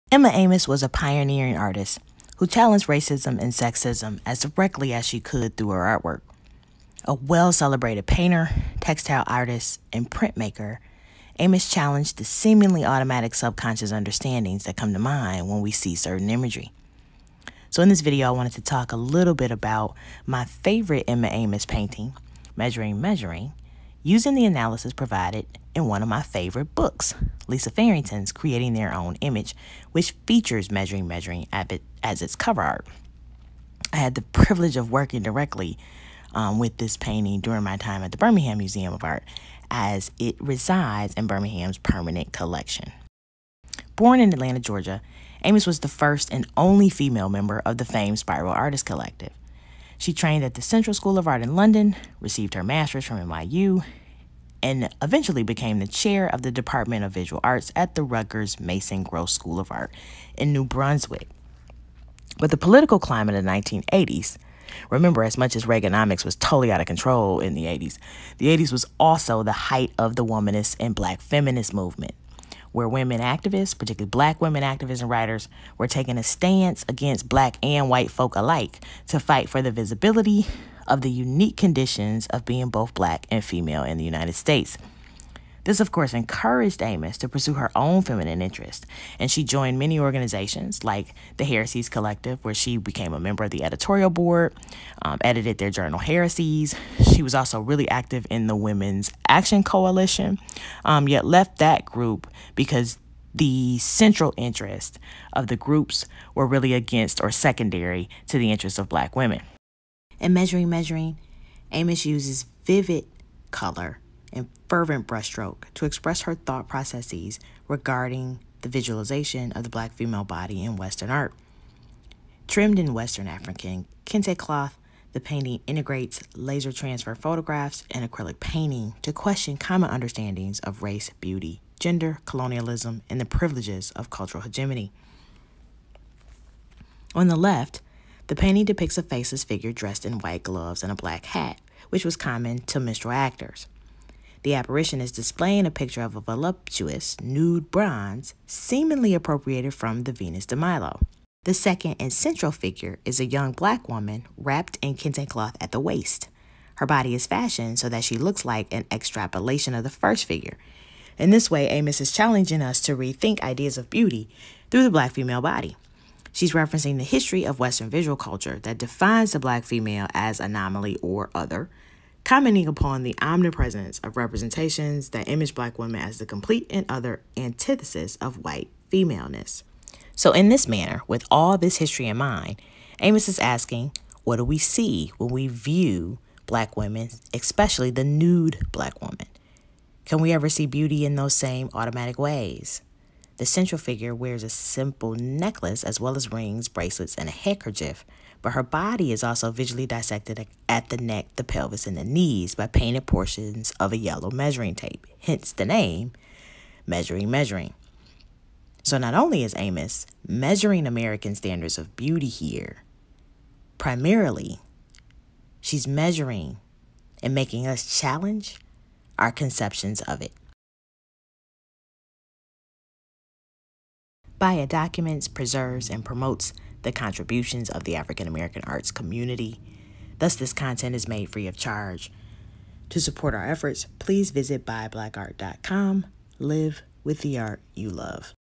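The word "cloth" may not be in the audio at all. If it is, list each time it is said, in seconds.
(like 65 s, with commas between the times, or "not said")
124 s, 155 s.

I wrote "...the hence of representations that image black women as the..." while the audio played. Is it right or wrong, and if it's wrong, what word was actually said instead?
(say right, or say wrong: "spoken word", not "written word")
wrong: "omnipresence", not "hence".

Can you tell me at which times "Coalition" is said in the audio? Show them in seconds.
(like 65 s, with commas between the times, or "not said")
99 s.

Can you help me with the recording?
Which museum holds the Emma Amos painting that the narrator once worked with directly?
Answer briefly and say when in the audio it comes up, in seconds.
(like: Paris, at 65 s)
Birmingham Museum of Art, at 38 s.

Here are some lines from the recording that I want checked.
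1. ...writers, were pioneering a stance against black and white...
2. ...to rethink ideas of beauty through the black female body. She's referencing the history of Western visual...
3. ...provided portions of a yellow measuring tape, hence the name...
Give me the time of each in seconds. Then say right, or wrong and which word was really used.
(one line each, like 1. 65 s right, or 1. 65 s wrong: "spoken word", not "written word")
1. 75 s wrong: "taking", not "pioneering"
2. 162 s right
3. 202 s wrong: "painted", not "provided".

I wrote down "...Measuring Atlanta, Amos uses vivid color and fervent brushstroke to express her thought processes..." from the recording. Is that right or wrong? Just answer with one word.
wrong.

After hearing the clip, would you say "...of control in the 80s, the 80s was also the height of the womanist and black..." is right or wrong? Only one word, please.
right.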